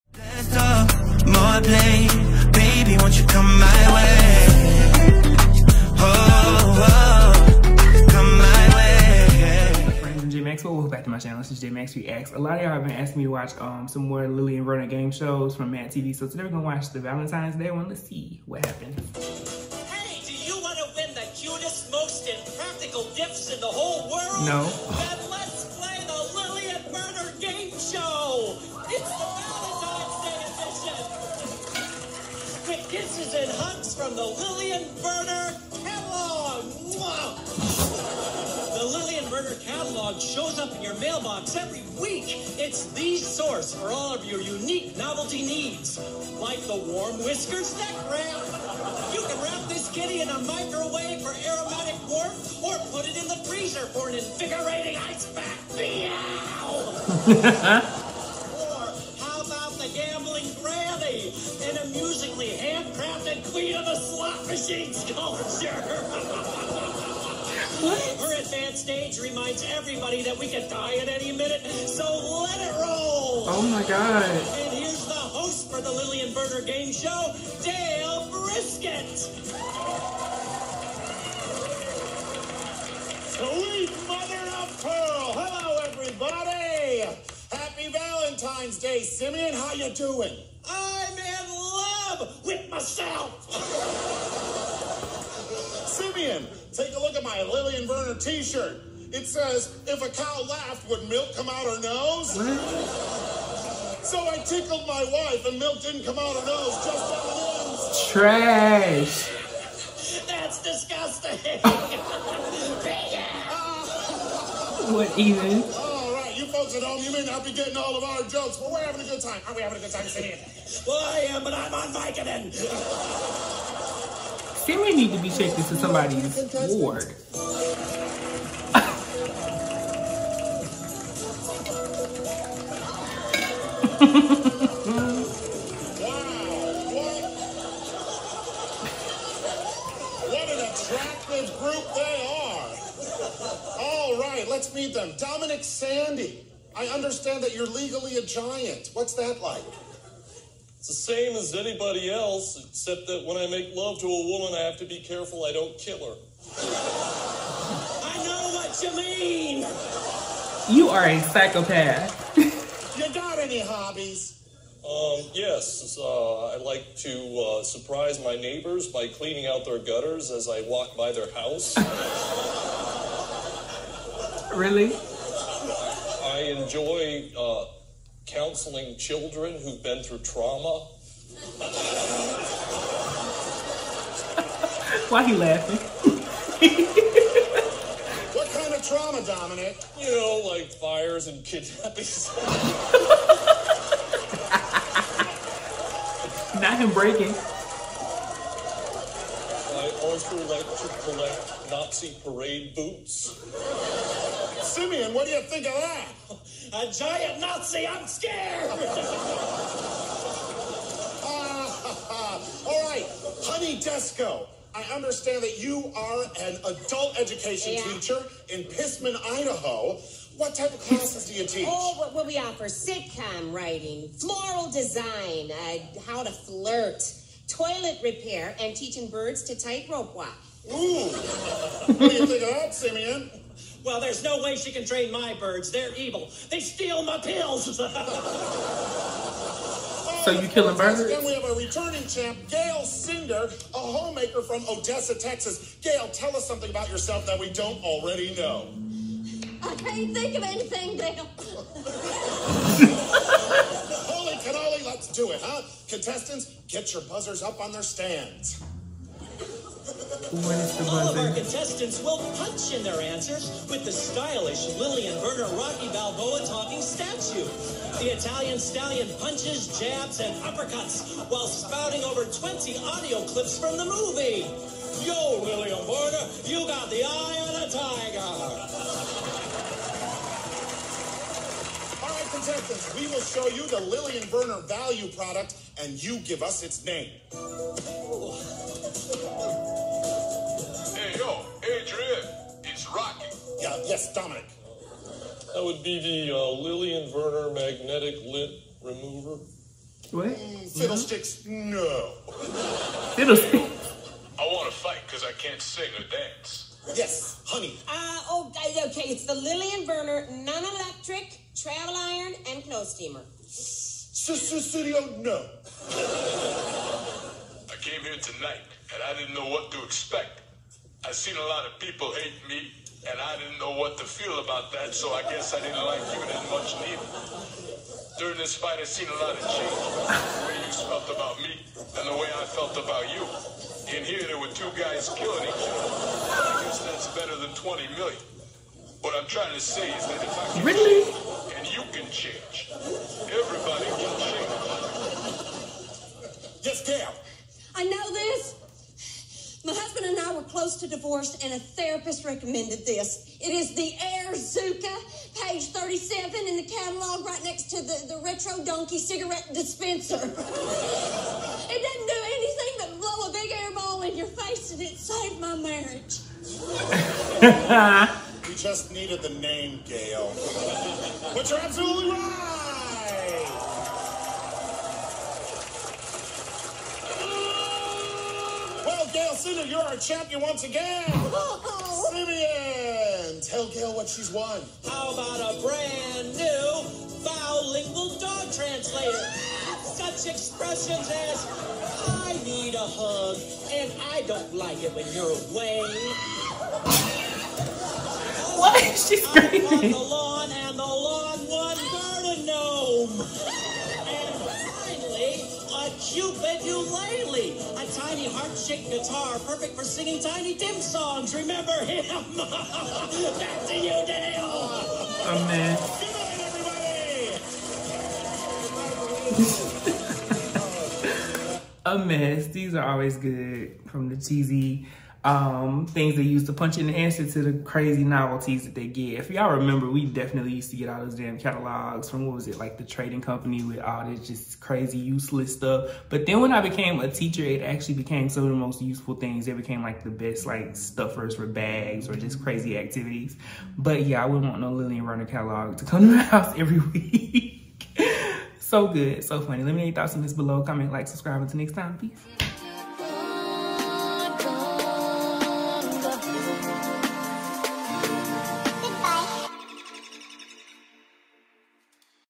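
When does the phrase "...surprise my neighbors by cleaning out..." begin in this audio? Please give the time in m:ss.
2:47.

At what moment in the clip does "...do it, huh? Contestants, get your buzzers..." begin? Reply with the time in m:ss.
4:15.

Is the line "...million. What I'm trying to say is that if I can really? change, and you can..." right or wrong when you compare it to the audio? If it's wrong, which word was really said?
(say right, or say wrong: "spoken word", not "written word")
right.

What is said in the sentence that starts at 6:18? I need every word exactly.
Well, Gail Singer, you're our champion once again!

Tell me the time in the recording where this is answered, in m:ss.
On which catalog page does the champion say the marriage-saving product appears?
5:55.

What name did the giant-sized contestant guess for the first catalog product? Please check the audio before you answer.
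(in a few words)
magnetic lint remover.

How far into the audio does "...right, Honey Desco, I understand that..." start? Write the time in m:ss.
3:32.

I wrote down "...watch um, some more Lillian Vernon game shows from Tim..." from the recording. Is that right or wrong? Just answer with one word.
wrong.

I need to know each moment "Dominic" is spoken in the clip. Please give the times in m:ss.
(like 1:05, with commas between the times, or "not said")
2:25, 3:09, 4:54.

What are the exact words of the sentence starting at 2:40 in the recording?
You are a psychopath any hobbies?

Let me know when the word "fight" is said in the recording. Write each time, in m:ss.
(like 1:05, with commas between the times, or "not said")
5:04, 5:28.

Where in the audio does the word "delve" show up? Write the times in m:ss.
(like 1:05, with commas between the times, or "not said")
not said.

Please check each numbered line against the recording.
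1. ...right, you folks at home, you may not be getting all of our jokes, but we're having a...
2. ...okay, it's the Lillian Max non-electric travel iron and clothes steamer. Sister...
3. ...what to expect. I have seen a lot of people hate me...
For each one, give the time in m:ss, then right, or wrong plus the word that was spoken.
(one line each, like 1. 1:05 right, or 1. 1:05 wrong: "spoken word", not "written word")
1. 1:56 right
2. 5:08 wrong: "Vernon", not "Max"
3. 5:19 right.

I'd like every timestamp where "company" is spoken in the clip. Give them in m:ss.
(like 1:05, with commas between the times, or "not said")
7:13.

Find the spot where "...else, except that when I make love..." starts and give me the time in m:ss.
2:32.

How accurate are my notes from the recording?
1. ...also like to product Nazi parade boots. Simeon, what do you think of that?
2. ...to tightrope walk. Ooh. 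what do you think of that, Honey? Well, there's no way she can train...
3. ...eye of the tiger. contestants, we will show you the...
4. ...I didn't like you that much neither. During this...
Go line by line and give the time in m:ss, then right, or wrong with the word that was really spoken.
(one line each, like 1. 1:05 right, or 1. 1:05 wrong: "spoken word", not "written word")
1. 3:20 wrong: "collect", not "product"
2. 3:49 wrong: "Simeon", not "Honey"
3. 4:37 right
4. 5:25 right.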